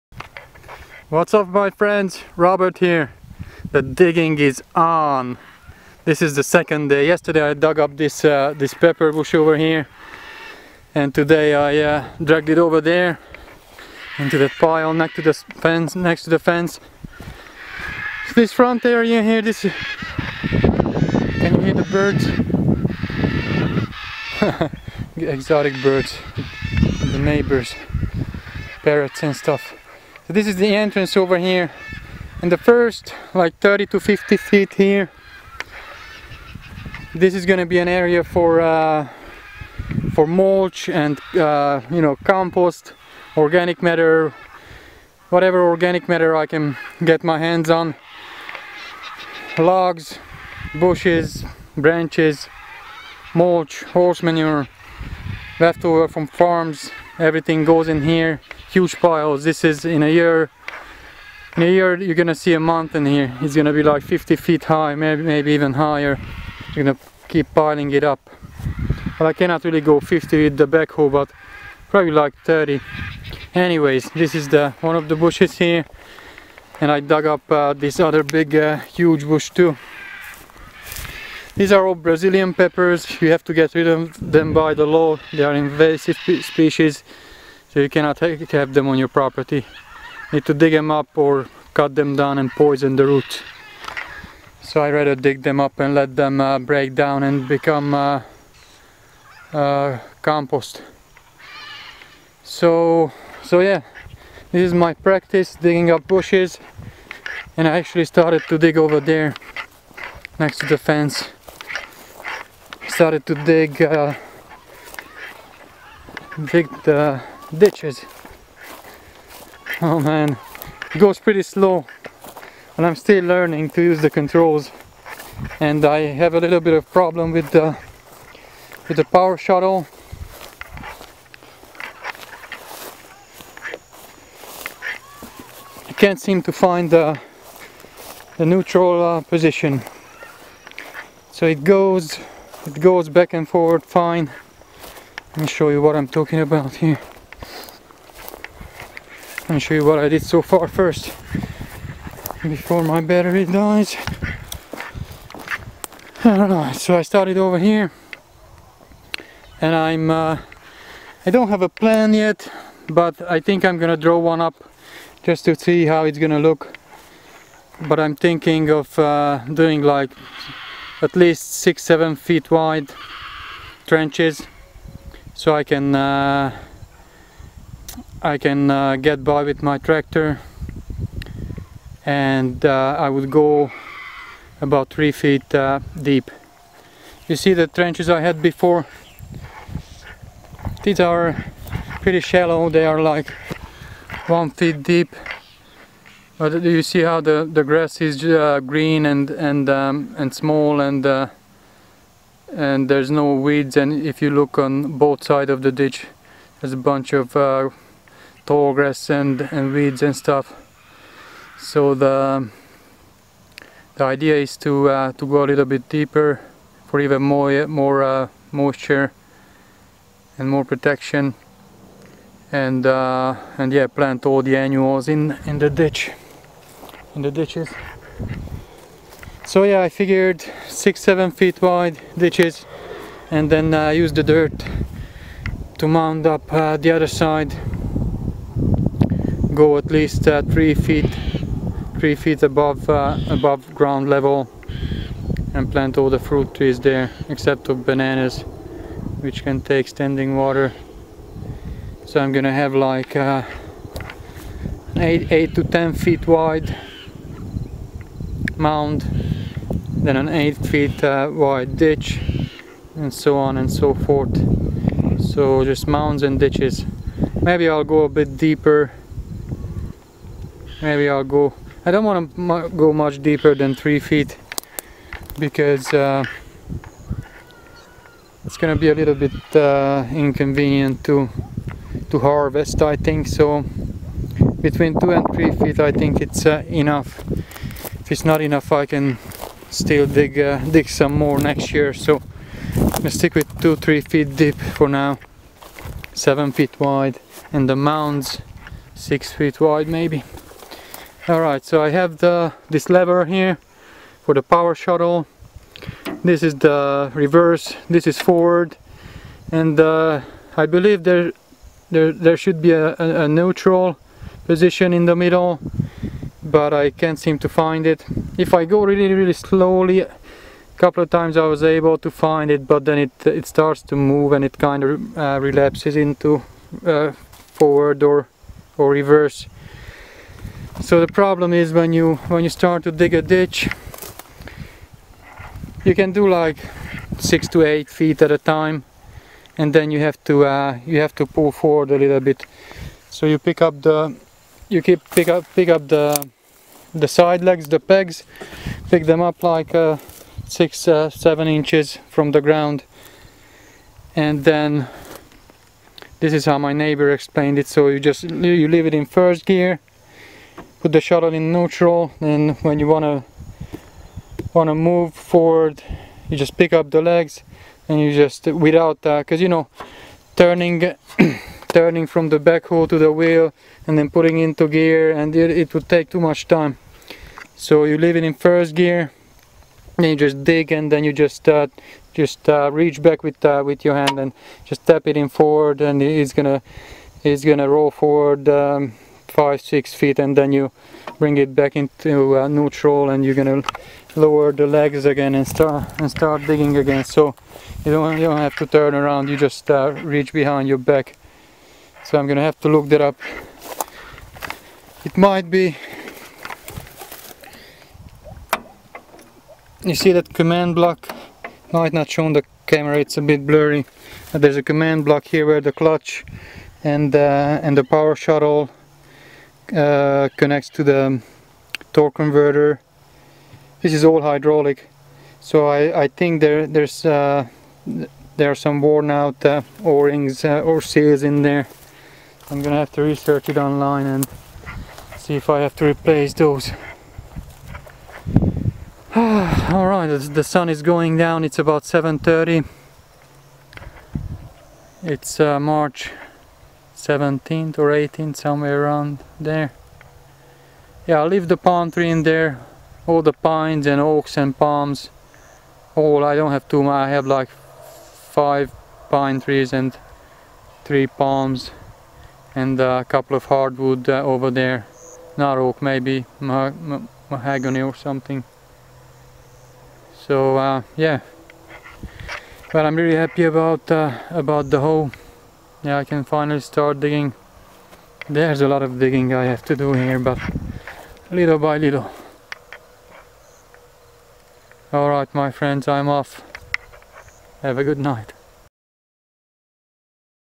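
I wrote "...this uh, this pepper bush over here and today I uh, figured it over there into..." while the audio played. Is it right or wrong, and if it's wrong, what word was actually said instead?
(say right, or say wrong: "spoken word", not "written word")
wrong: "dragged", not "figured".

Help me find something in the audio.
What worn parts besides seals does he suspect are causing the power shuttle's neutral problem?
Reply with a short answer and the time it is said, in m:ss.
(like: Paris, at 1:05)
o-rings, at 7:09.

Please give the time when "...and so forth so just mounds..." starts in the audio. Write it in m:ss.
4:23.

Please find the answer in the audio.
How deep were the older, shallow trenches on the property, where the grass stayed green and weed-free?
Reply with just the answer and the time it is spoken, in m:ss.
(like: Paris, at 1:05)
1 foot, at 3:14.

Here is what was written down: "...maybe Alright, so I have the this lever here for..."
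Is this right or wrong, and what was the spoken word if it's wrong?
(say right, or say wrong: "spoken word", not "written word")
right.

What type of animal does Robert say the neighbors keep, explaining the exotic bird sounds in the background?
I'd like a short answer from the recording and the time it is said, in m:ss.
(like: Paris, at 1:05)
parrots, at 0:28.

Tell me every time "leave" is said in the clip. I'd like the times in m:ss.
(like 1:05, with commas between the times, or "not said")
5:58, 6:17, 7:31.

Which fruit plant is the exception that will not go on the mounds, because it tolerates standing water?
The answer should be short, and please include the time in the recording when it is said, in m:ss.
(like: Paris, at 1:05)
bananas, at 4:07.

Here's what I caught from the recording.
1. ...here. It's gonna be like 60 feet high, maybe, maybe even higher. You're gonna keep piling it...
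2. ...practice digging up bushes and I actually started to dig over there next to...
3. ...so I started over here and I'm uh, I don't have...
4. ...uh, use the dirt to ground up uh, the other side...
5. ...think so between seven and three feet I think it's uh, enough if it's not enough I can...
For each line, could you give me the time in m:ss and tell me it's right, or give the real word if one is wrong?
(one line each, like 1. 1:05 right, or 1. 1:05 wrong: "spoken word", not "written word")
1. 1:03 wrong: "50", not "60"
2. 1:44 right
3. 2:36 right
4. 3:53 wrong: "mound", not "ground"
5. 4:42 wrong: "two", not "seven".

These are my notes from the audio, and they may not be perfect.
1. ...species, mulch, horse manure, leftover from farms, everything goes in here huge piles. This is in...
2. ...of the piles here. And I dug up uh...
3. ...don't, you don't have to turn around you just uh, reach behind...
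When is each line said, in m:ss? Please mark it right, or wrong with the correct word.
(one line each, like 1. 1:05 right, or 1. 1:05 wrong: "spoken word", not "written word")
1. 0:51 wrong: "branches", not "species"
2. 1:14 wrong: "bushes", not "piles"
3. 6:37 right.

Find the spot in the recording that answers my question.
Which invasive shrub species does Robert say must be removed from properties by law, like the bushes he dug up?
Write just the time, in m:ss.
1:21.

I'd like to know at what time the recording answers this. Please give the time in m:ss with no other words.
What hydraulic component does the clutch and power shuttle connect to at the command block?
7:01.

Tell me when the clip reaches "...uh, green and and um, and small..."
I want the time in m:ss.
3:18.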